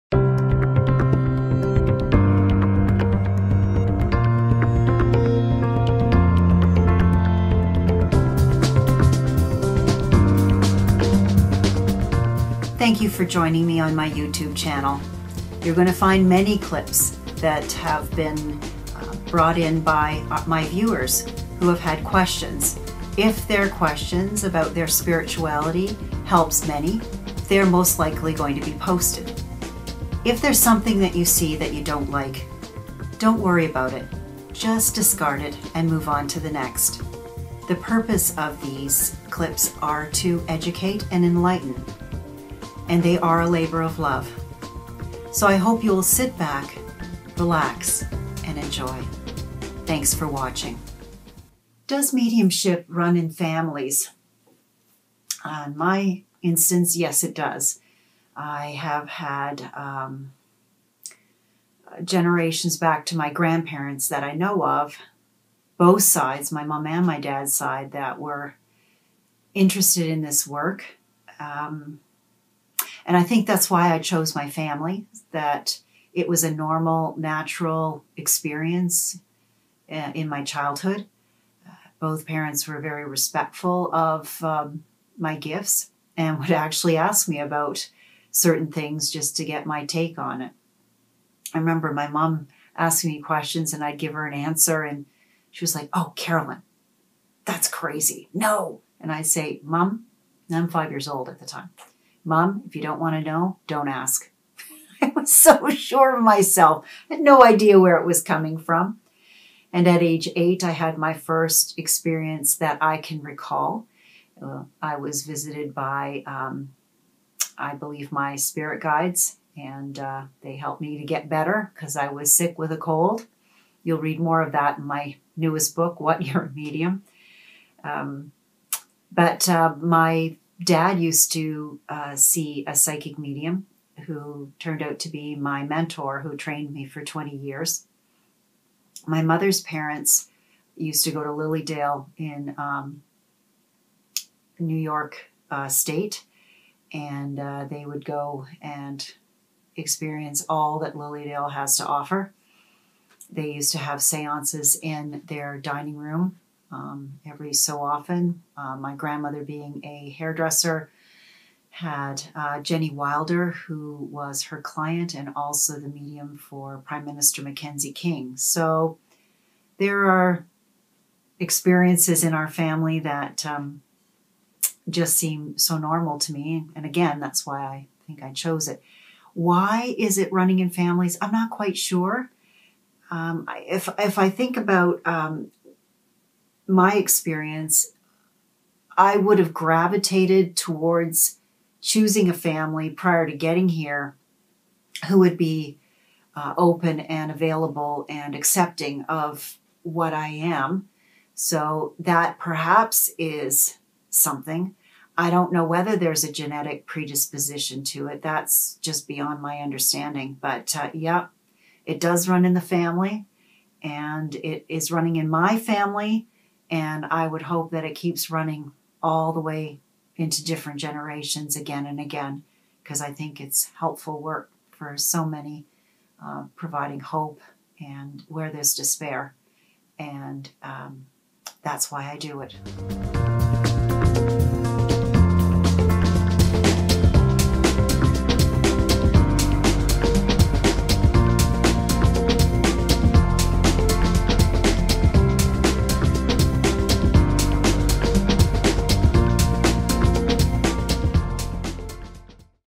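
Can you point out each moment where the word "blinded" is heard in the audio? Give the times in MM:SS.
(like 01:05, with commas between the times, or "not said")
not said.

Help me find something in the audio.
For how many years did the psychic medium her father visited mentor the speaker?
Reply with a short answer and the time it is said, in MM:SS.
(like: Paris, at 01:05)
20, at 02:17.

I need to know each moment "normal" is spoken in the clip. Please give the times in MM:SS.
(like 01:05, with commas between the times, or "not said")
01:16, 02:55.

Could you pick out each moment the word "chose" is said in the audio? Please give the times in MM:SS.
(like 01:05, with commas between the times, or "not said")
01:13, 02:58.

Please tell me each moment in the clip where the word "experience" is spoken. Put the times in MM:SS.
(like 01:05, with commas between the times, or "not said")
01:18, 01:51, 02:29, 02:51, 03:06.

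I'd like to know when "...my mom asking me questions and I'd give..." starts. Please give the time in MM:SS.
01:31.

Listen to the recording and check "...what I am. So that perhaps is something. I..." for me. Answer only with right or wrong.
right.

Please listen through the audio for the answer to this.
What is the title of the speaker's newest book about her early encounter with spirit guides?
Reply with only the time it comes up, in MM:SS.
02:05.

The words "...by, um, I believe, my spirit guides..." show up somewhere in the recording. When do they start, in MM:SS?
01:55.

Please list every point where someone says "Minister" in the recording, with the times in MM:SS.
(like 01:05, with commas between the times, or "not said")
02:47.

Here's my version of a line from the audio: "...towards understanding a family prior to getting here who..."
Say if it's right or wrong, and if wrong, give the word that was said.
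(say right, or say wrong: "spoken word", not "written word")
wrong: "choosing", not "understanding".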